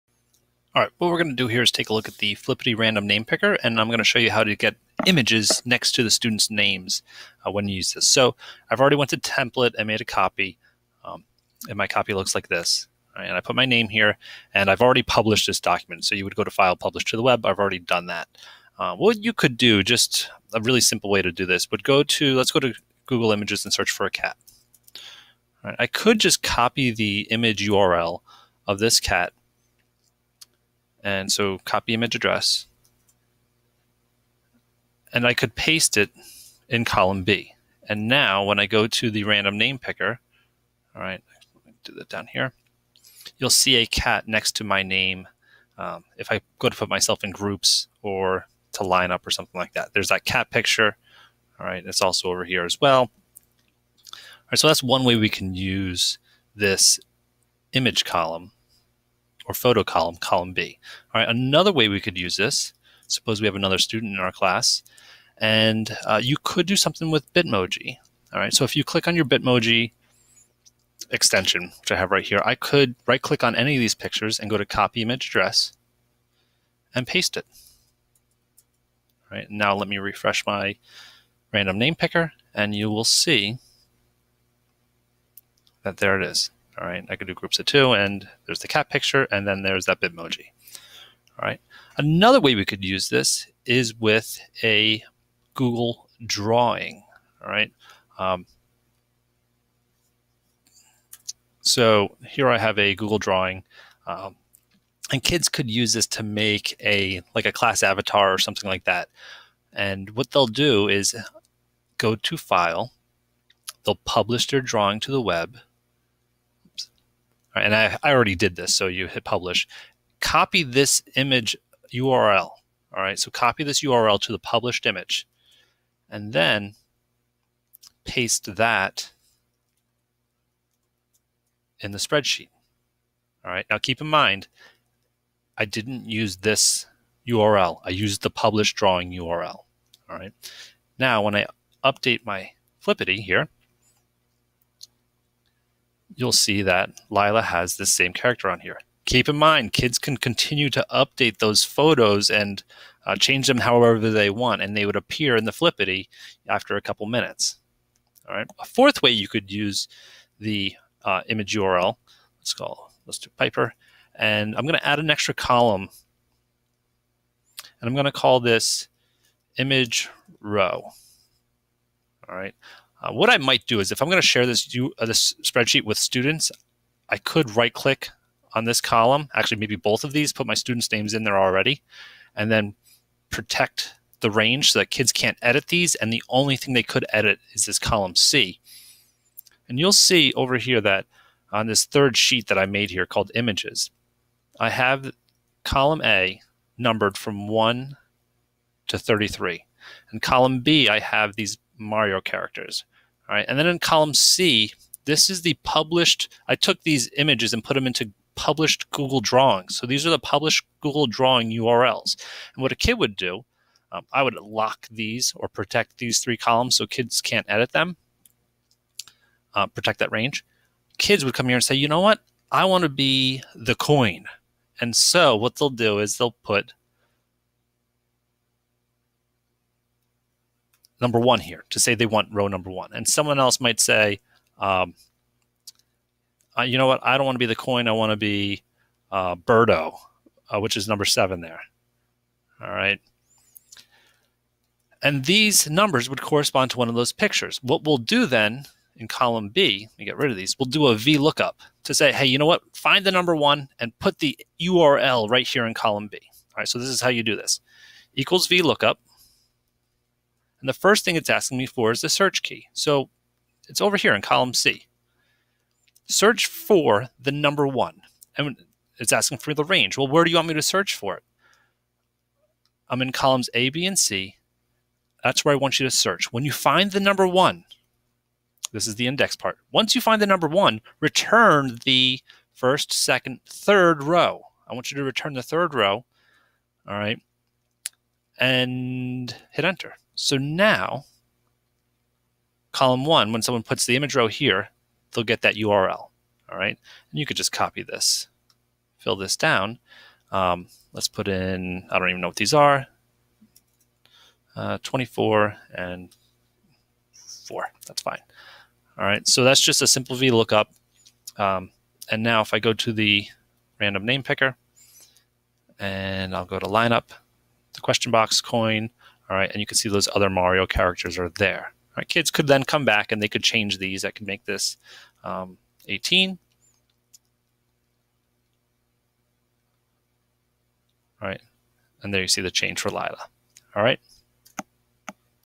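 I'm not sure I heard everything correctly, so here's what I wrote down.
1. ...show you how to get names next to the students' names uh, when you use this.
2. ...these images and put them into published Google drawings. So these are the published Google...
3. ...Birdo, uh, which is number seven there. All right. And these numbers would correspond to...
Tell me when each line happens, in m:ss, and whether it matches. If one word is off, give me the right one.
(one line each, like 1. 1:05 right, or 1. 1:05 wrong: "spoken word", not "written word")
1. 0:04 wrong: "images", not "names"
2. 3:26 right
3. 3:59 right.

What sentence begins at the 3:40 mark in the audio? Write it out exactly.
Kids would come here and say, you know what?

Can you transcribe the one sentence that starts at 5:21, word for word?
All right, kids could then come back and they could change these.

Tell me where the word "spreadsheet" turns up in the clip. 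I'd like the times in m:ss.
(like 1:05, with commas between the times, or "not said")
2:11, 2:55.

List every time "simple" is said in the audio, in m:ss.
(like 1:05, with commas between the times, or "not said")
0:20, 5:09.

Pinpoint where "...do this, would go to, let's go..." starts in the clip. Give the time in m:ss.
0:21.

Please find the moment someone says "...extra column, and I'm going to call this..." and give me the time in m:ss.
2:45.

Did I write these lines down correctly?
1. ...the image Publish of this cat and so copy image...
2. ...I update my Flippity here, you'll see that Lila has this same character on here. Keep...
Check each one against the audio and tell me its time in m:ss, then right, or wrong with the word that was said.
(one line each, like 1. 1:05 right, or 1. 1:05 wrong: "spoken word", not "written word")
1. 0:26 wrong: "URL", not "Publish"
2. 2:21 right.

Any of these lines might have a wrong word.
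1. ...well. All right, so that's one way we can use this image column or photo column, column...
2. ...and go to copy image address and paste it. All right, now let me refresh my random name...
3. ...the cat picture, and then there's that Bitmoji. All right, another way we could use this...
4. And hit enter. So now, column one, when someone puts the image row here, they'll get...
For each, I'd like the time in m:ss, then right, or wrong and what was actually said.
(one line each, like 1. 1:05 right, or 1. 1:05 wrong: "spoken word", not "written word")
1. 0:52 right
2. 1:14 right
3. 1:28 right
4. 4:48 right.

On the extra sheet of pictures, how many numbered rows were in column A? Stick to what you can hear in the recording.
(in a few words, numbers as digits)
33.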